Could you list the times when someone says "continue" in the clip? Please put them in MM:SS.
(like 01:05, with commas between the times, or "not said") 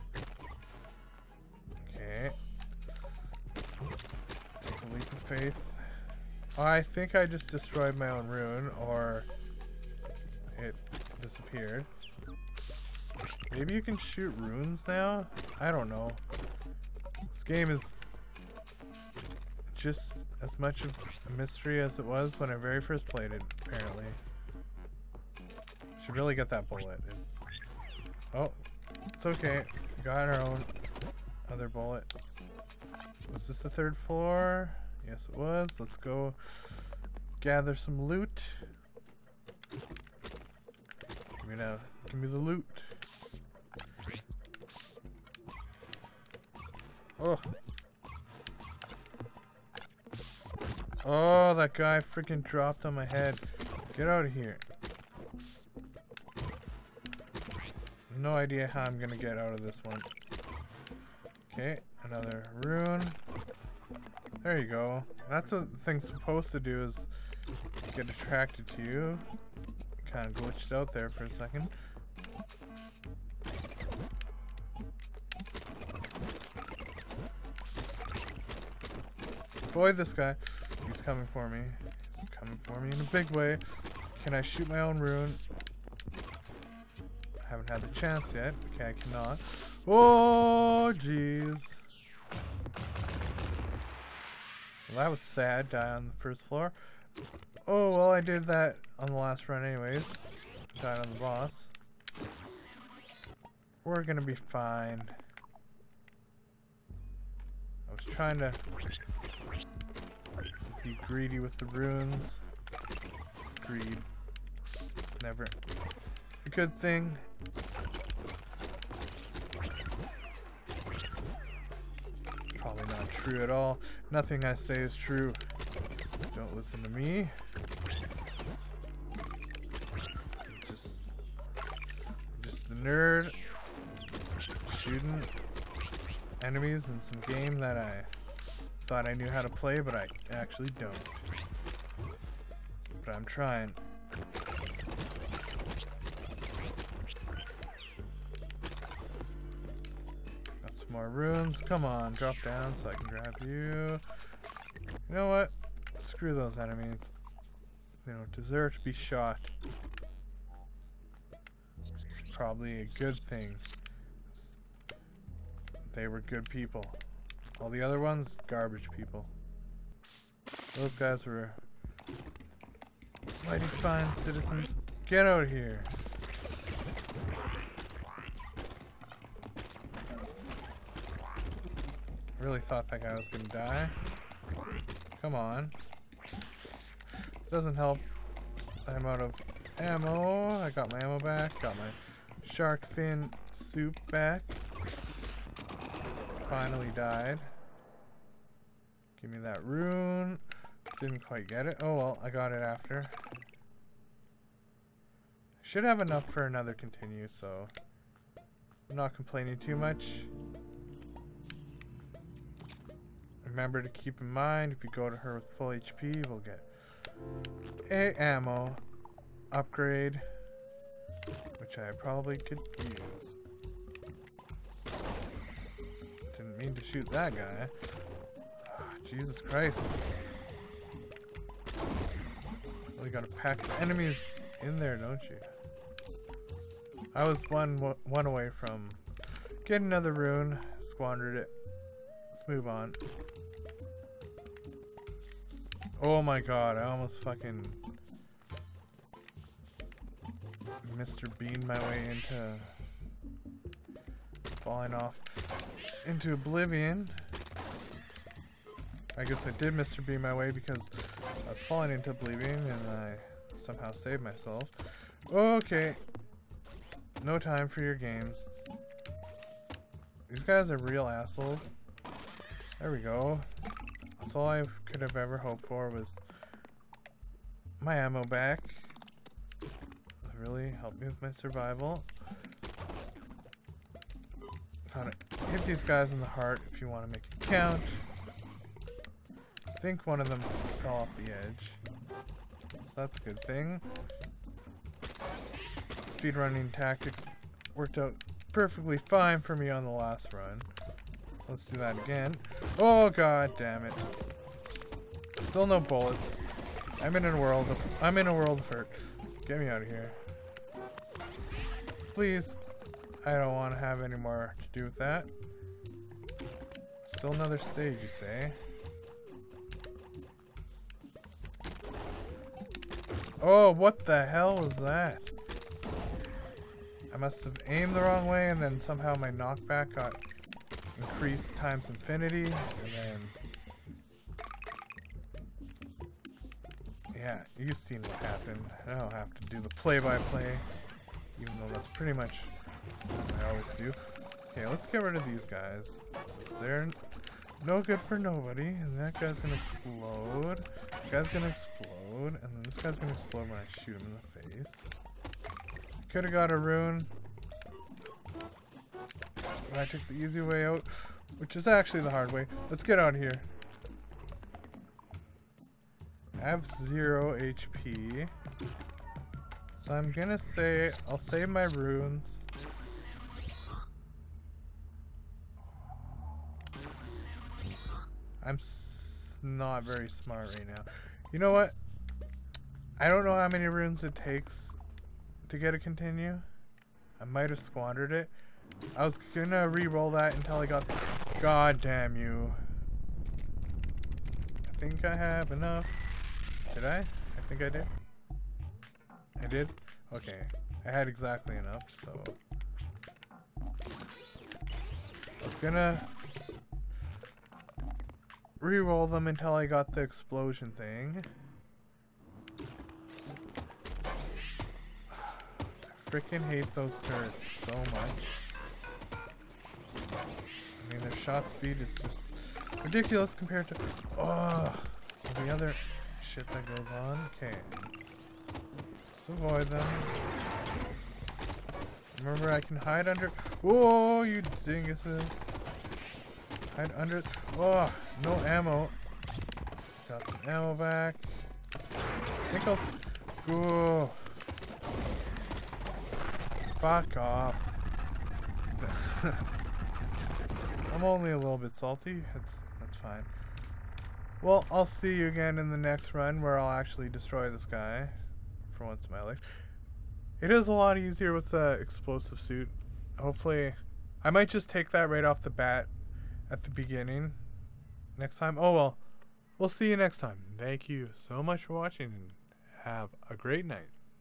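03:26, 06:25.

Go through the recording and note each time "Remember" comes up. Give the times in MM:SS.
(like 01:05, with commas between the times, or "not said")
03:33, 07:12.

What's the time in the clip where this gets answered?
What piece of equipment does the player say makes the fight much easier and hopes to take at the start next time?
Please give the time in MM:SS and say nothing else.
07:41.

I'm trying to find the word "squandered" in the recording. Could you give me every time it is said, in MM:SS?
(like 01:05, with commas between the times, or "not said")
04:00, 06:27.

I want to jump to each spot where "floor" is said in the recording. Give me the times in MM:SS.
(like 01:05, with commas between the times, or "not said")
00:33, 01:36.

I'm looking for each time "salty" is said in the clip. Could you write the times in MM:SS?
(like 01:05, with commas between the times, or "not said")
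07:31.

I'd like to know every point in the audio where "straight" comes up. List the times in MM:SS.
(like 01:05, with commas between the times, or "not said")
not said.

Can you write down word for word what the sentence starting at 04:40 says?
really helped me with my survival.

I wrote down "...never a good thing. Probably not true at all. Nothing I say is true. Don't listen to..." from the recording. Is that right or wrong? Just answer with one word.
right.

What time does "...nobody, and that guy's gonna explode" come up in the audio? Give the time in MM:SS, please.
05:48.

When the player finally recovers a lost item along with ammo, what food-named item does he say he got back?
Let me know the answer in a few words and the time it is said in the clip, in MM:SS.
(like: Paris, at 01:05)
shark fin soup, at 03:12.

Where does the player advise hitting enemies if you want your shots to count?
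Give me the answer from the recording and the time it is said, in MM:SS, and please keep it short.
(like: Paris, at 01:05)
in the heart, at 04:46.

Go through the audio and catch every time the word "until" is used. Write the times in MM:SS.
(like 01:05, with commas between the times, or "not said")
06:30, 06:49.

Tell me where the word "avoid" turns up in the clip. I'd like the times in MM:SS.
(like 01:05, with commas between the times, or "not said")
01:19, 07:09.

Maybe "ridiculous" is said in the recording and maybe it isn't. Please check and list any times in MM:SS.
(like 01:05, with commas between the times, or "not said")
07:02.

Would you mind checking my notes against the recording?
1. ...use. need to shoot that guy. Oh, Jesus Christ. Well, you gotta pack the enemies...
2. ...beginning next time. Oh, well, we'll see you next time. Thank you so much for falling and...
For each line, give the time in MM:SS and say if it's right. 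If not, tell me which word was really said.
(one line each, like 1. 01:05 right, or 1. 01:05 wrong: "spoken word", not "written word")
1. 03:42 right
2. 07:46 wrong: "watching", not "falling".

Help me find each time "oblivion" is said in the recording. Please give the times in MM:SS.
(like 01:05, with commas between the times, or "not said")
04:16, 04:22.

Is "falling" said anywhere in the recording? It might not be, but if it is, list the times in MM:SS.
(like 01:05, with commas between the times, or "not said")
04:14, 04:21.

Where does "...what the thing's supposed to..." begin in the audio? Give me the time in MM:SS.
01:05.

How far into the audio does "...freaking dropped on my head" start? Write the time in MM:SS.
00:52.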